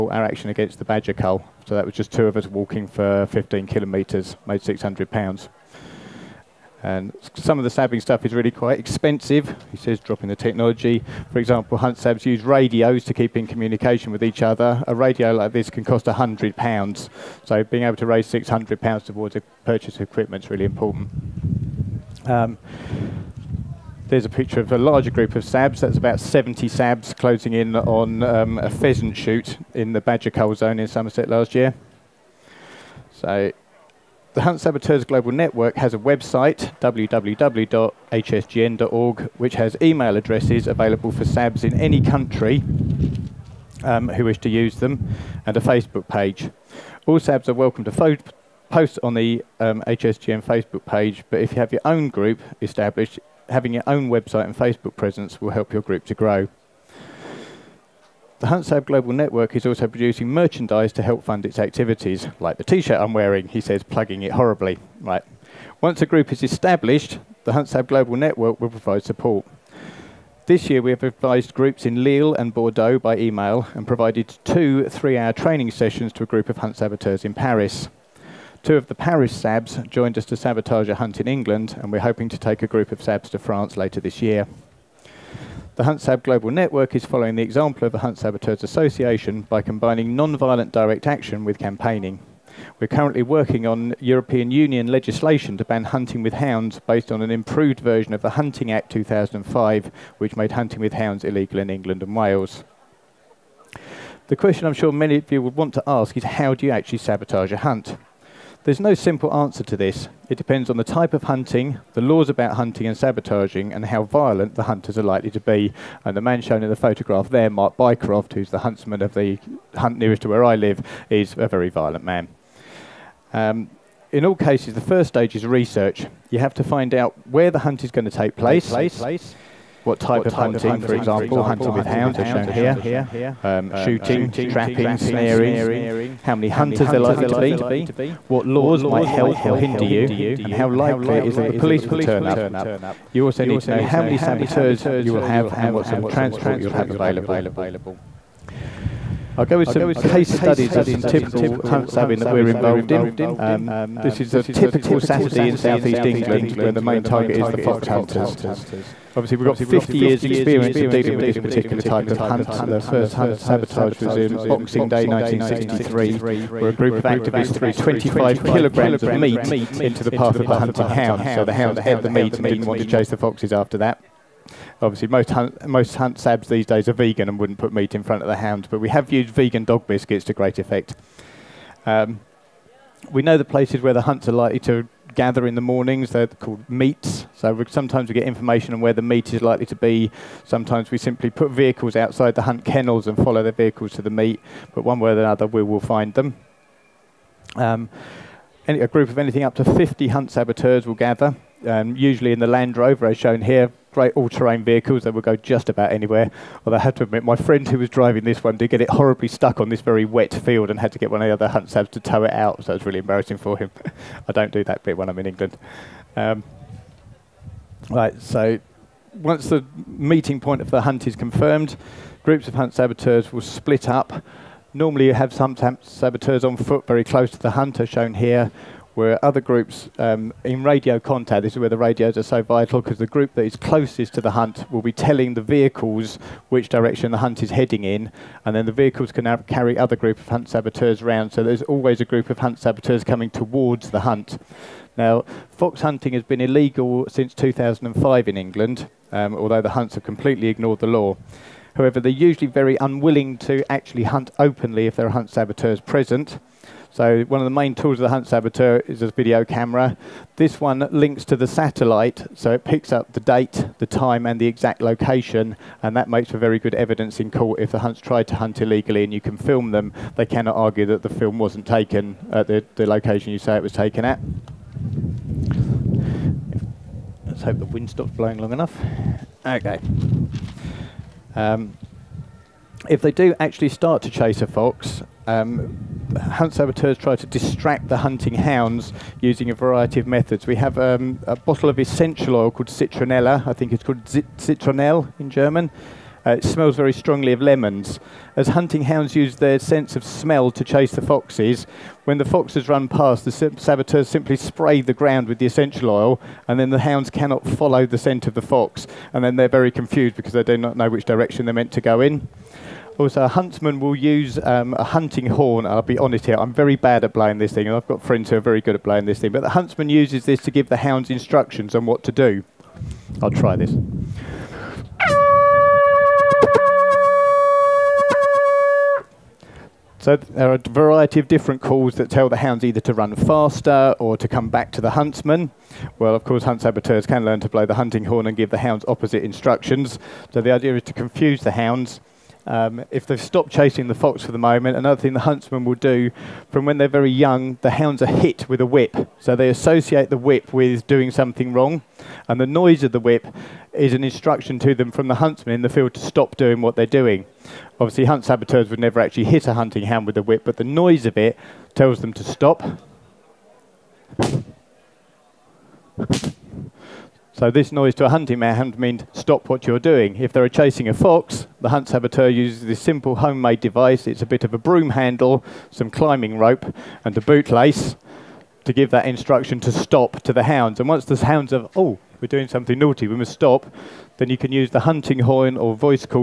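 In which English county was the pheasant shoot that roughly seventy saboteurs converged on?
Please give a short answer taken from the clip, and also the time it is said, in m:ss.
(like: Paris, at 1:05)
Somerset, at 0:30.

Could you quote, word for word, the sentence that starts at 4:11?
However, they're usually very unwilling to actually hunt openly if there are hunt saboteurs present.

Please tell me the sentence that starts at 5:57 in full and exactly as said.
Obviously, hunt saboteurs would never actually hit a hunting hound with a whip, but the noise of it tells them to stop.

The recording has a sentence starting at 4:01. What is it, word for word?
So there's always a group of hunt saboteurs coming towards the hunt.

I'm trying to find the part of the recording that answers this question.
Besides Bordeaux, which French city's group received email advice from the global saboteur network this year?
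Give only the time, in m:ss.
1:12.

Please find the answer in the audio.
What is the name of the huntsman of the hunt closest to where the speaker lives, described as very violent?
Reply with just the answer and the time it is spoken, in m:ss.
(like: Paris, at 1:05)
Mark Bycroft, at 1:57.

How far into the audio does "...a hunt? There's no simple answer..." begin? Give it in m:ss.
1:47.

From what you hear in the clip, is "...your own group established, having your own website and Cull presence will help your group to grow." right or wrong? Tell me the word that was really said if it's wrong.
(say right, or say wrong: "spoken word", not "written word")
wrong: "Facebook", not "Cull".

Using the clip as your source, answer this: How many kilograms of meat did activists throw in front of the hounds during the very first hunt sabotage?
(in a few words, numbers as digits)
25 kilograms.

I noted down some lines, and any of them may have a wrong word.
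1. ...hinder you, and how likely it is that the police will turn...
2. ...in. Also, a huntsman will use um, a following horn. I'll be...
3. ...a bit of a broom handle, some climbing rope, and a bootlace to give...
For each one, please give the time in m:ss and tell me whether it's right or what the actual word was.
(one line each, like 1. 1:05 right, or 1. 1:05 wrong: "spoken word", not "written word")
1. 2:19 right
2. 5:11 wrong: "hunting", not "following"
3. 6:14 right.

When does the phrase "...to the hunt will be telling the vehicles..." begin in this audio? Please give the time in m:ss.
3:54.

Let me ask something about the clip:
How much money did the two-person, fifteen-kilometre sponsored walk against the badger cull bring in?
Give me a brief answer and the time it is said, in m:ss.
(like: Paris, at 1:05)
£600, at 0:04.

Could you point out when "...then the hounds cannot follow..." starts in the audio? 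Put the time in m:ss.
5:06.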